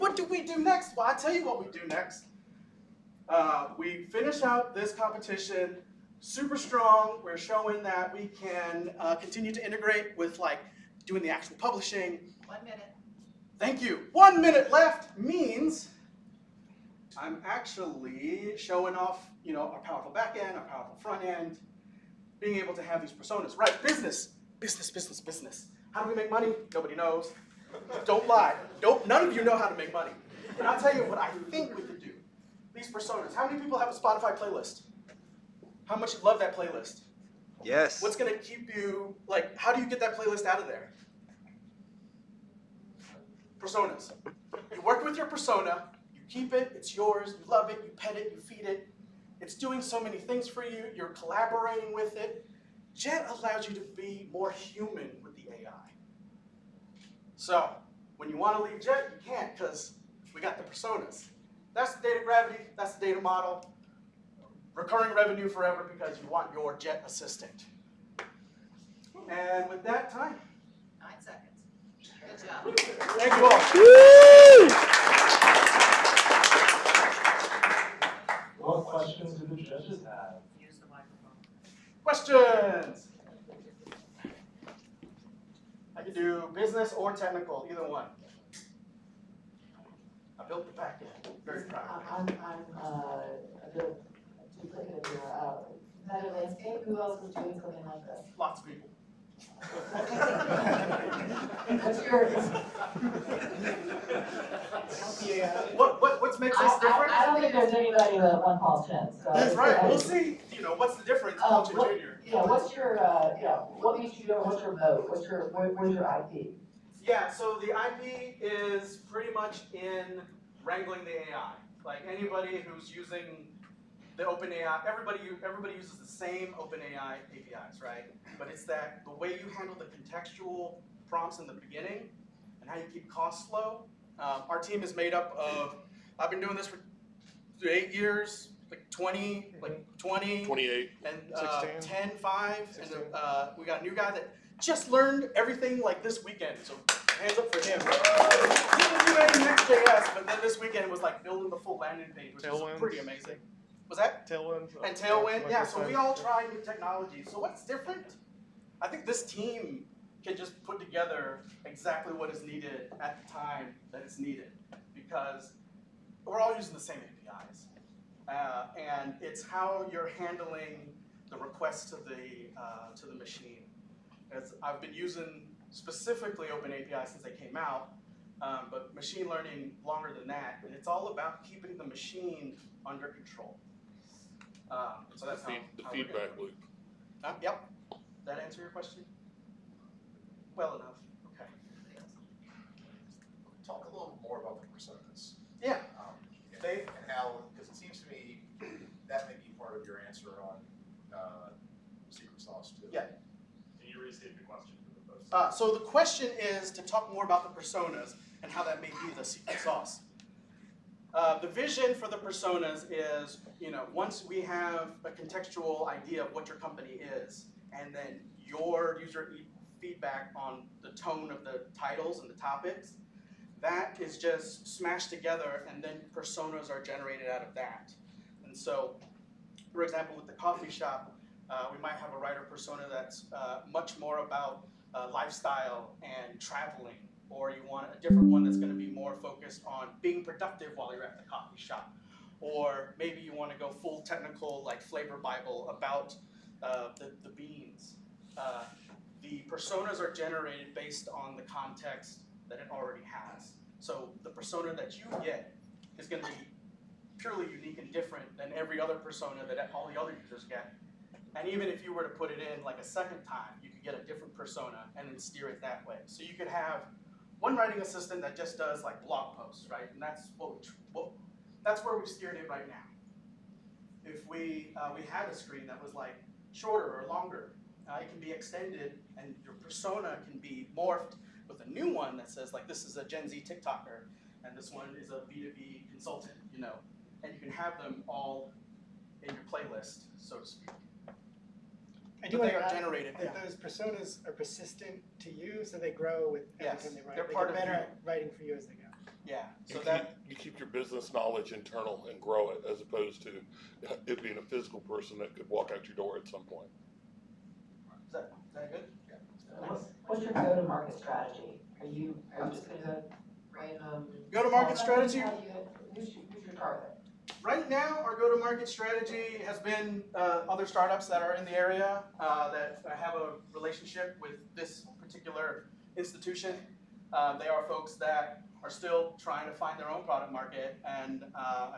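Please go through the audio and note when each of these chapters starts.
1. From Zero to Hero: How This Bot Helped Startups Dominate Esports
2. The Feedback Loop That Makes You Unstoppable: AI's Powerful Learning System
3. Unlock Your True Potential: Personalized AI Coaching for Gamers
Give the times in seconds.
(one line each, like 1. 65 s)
1. 300 s
2. 171 s
3. 24 s.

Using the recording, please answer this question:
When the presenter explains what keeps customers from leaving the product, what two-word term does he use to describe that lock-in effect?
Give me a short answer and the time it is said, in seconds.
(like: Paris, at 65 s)
data gravity, at 62 s.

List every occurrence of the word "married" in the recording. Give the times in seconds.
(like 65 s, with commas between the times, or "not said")
not said.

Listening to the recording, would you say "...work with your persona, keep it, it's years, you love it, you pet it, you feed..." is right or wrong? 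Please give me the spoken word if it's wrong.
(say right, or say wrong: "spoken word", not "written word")
wrong: "yours", not "years".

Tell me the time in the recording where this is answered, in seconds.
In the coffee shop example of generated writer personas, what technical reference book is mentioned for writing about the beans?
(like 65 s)
244 s.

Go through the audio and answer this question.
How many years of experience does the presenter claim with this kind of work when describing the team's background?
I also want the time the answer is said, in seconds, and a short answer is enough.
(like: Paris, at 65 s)
8, at 137 s.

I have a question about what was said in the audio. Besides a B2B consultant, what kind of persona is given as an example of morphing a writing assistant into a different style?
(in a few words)
Gen Z TikToker.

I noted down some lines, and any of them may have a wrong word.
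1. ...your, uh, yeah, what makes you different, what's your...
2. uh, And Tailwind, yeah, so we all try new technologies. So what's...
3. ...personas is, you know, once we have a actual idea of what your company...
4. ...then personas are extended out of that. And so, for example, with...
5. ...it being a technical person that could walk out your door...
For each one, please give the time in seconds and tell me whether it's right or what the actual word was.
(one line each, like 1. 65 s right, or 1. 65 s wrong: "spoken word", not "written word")
1. 112 s right
2. 154 s right
3. 212 s wrong: "contextual", not "actual"
4. 225 s wrong: "generated", not "extended"
5. 304 s wrong: "physical", not "technical".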